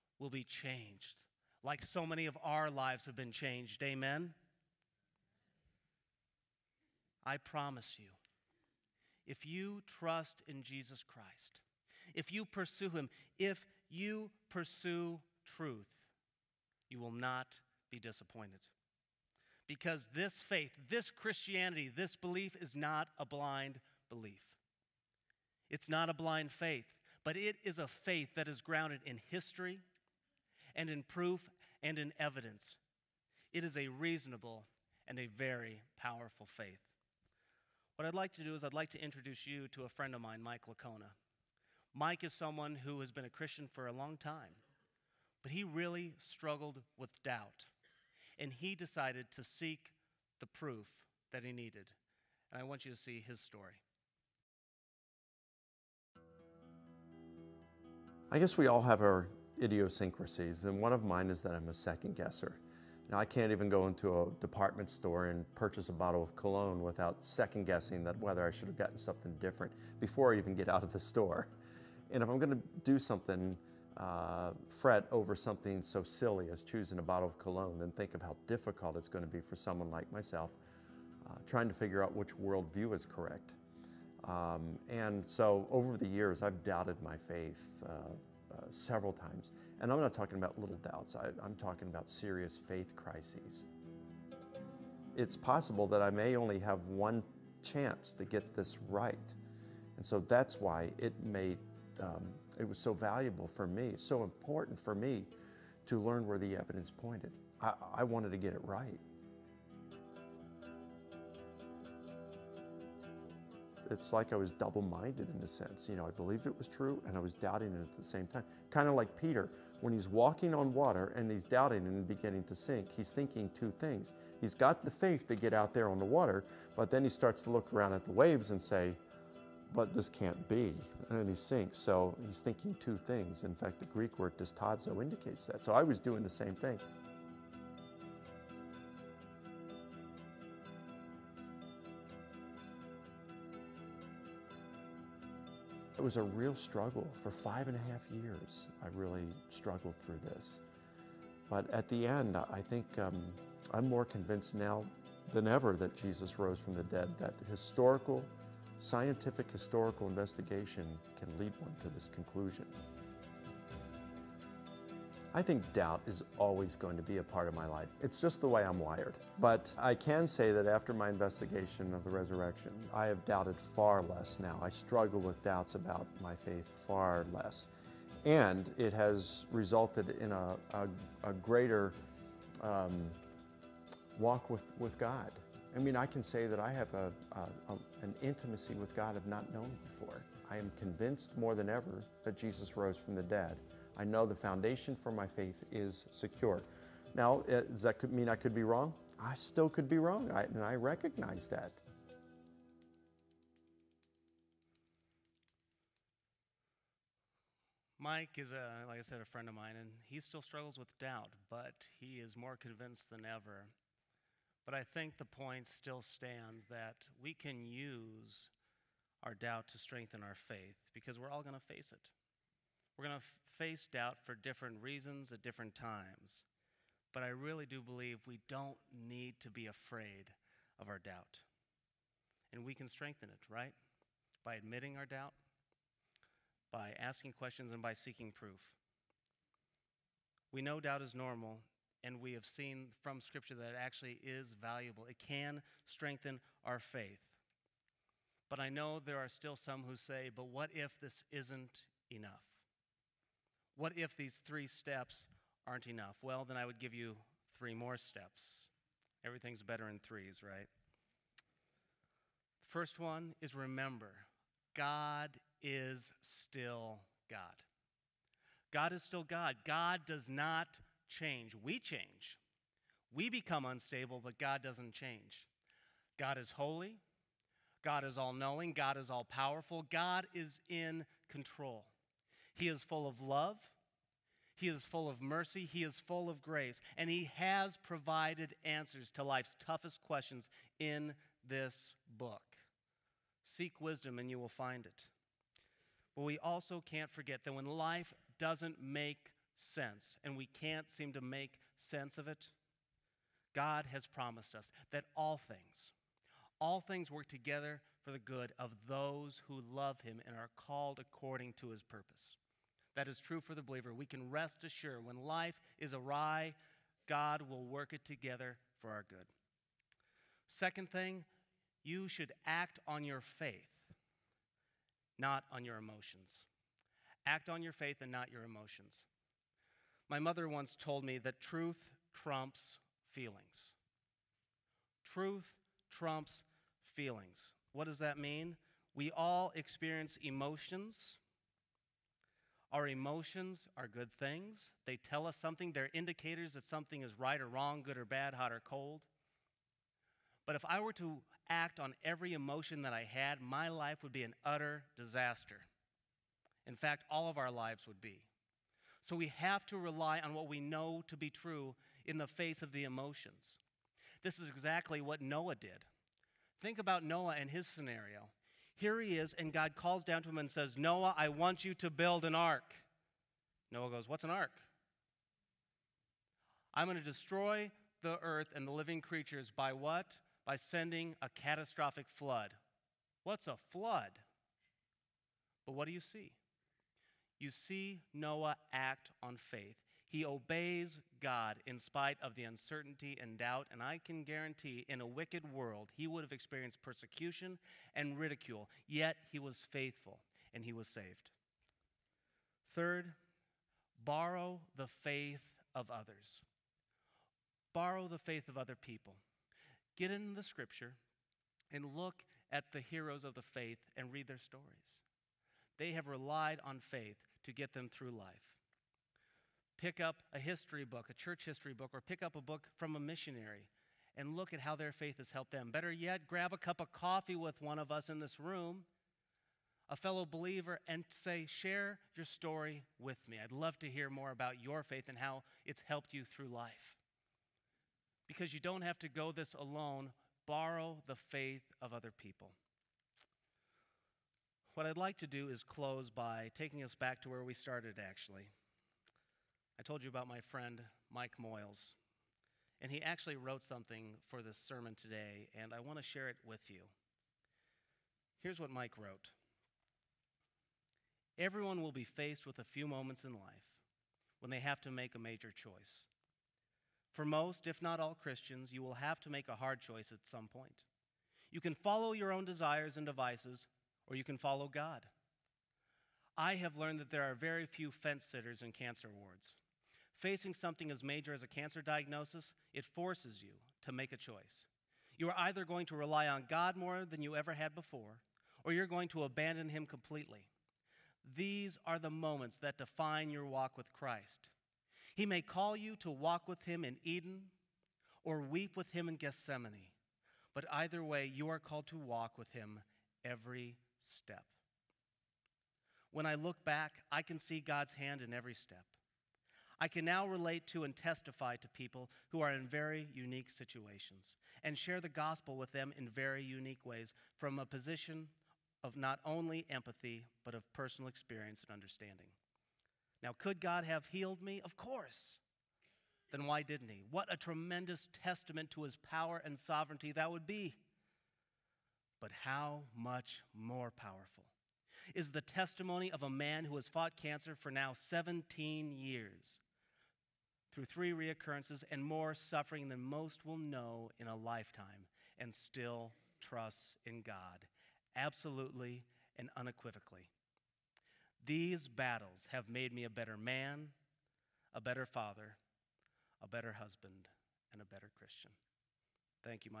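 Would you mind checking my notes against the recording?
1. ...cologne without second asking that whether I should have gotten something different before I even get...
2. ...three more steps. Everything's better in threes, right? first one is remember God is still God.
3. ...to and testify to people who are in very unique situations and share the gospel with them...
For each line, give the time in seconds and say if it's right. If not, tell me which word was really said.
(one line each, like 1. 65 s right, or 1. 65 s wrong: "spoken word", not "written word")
1. 66 s wrong: "guessing", not "asking"
2. 257 s right
3. 510 s right.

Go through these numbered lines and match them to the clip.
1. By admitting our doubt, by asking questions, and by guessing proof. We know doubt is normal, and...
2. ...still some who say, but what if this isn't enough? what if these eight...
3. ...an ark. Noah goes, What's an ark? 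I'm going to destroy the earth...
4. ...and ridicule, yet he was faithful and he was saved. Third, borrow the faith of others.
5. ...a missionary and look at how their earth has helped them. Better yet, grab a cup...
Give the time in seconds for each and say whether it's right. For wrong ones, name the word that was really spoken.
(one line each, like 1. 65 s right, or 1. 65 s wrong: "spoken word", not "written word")
1. 234 s wrong: "seeking", not "guessing"
2. 249 s wrong: "three", not "eight"
3. 372 s right
4. 397 s right
5. 422 s wrong: "faith", not "earth".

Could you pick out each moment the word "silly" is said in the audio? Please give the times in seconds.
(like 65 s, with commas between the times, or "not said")
76 s.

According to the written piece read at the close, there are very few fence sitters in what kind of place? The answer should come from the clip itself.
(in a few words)
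cancer wards.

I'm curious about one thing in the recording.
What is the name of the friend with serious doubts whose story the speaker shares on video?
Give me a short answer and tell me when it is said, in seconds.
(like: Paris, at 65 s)
Mike Licona, at 40 s.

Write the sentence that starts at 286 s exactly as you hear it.
And He has provided answers to life's toughest questions in this book.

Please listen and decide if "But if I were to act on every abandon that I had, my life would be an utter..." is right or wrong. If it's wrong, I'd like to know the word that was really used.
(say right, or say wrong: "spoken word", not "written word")
wrong: "emotion", not "abandon".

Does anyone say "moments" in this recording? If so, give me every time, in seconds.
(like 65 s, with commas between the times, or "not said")
462 s, 492 s.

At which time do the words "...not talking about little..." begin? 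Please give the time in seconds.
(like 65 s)
89 s.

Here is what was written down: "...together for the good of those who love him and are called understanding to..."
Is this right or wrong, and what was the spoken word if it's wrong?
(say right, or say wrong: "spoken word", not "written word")
wrong: "according", not "understanding".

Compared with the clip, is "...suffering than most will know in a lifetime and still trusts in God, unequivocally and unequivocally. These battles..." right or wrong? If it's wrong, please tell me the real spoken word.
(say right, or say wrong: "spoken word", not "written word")
wrong: "absolutely", not "unequivocally".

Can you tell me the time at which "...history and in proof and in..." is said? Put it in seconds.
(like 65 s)
29 s.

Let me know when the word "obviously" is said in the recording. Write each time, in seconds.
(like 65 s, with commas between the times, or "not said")
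not said.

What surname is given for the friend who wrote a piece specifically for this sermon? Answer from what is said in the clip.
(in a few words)
Moyles.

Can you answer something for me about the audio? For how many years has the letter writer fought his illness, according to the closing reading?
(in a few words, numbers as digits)
17.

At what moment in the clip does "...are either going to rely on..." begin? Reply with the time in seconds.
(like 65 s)
485 s.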